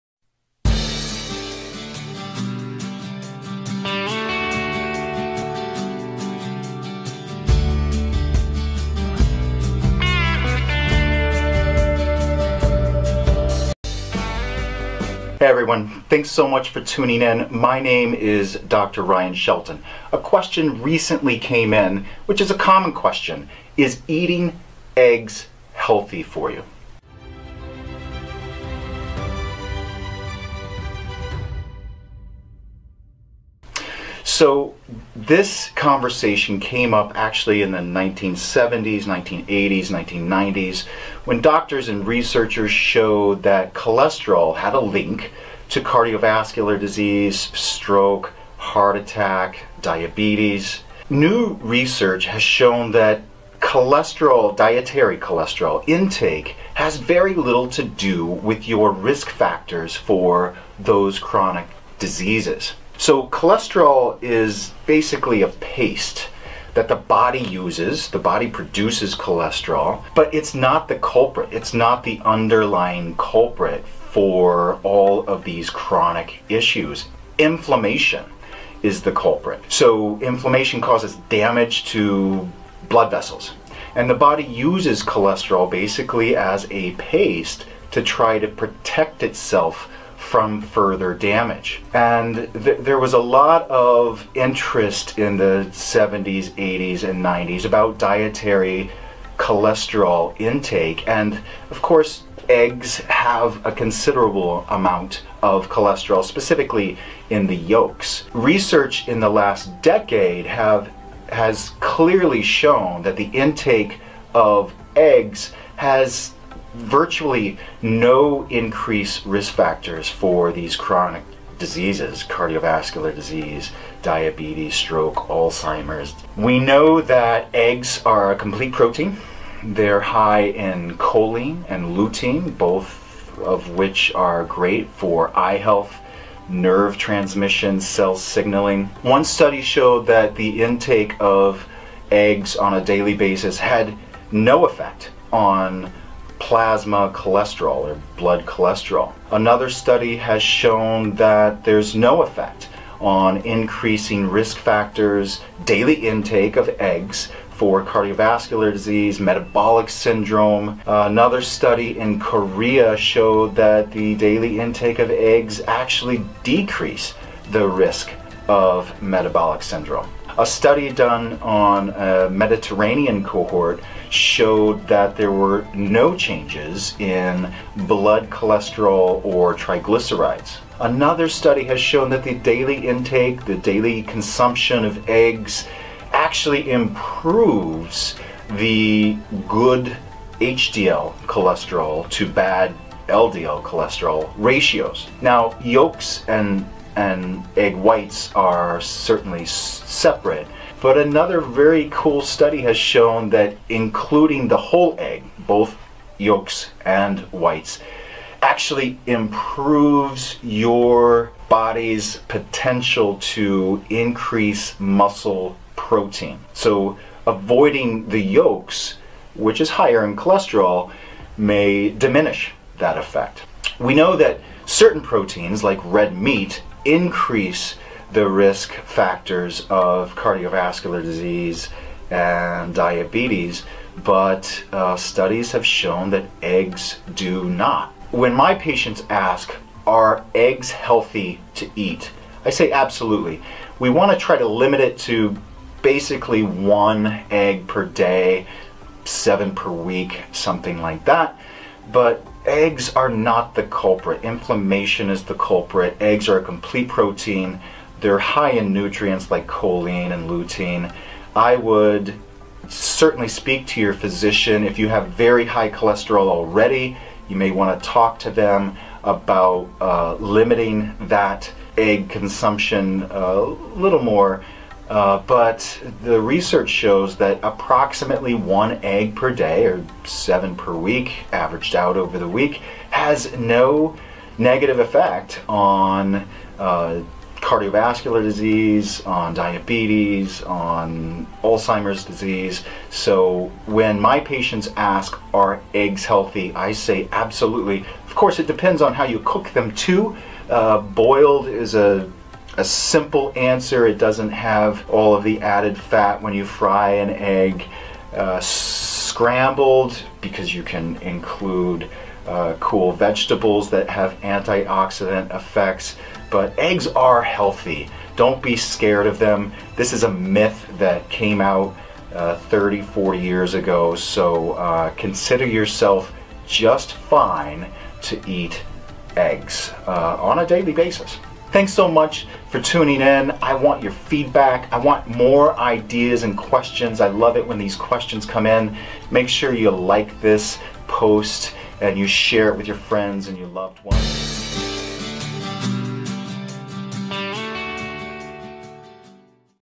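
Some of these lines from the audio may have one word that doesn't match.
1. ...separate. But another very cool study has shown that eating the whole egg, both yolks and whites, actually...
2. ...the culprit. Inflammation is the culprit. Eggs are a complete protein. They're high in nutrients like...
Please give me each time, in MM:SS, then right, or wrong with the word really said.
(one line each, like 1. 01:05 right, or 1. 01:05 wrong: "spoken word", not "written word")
1. 03:19 wrong: "including", not "eating"
2. 04:13 right.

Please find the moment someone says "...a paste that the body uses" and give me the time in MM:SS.
01:05.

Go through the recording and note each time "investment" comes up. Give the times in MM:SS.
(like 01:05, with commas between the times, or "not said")
not said.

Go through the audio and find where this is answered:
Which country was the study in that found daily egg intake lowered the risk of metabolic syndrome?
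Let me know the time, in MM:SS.
02:42.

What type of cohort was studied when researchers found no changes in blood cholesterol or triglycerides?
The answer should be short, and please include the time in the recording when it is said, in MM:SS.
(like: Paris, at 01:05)
Mediterranean, at 02:52.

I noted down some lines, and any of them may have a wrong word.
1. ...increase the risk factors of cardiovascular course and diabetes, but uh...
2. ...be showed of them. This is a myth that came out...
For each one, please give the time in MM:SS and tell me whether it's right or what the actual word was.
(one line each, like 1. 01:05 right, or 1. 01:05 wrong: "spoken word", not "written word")
1. 03:46 wrong: "disease", not "course"
2. 05:18 wrong: "scared", not "showed".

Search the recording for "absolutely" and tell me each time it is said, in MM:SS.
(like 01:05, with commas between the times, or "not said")
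04:02, 04:57.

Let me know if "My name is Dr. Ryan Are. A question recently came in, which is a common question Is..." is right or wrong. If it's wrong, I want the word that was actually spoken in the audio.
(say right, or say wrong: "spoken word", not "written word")
wrong: "Shelton", not "Are".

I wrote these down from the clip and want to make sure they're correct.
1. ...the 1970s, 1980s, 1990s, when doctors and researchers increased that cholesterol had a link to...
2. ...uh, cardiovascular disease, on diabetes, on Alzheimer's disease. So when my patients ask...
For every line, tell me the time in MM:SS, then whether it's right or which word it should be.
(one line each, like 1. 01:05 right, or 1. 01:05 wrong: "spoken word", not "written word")
1. 00:37 wrong: "showed", not "increased"
2. 04:46 right.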